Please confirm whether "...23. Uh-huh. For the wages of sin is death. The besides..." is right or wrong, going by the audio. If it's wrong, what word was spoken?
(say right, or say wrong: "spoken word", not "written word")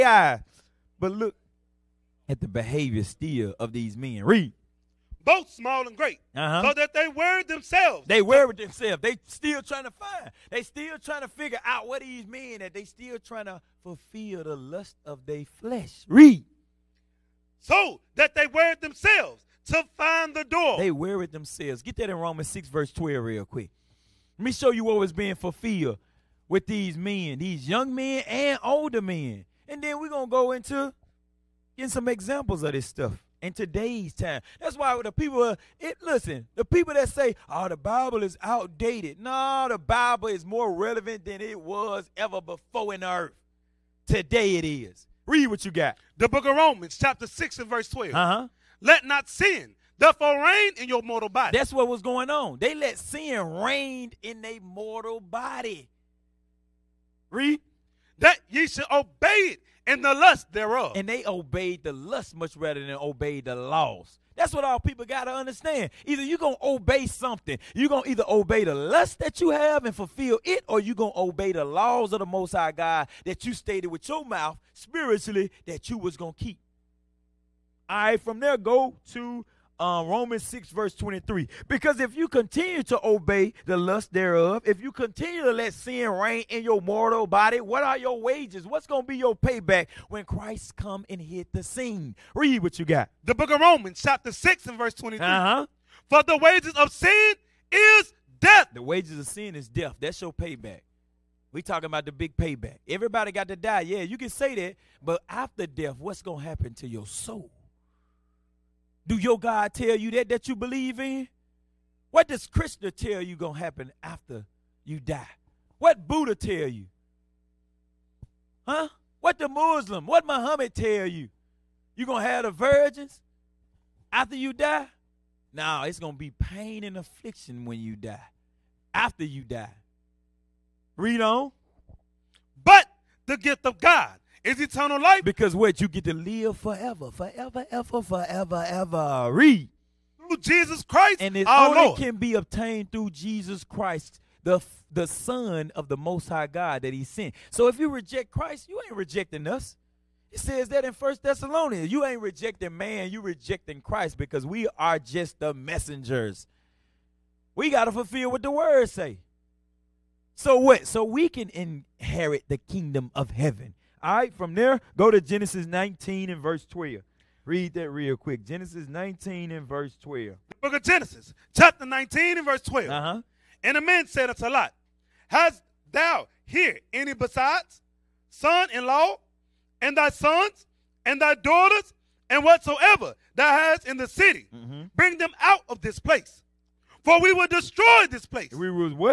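wrong: "wages", not "besides".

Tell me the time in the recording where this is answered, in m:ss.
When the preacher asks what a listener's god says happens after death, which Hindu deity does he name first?
1:52.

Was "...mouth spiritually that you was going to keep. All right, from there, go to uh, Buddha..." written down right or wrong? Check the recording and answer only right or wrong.
wrong.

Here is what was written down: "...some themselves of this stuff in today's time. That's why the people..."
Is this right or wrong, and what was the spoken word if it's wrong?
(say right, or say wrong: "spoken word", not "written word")
wrong: "examples", not "themselves".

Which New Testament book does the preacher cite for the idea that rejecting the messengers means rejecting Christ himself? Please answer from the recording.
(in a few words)
First Thessalonians.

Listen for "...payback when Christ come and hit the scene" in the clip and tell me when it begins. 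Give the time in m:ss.
1:29.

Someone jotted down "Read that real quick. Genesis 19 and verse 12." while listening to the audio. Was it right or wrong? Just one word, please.
right.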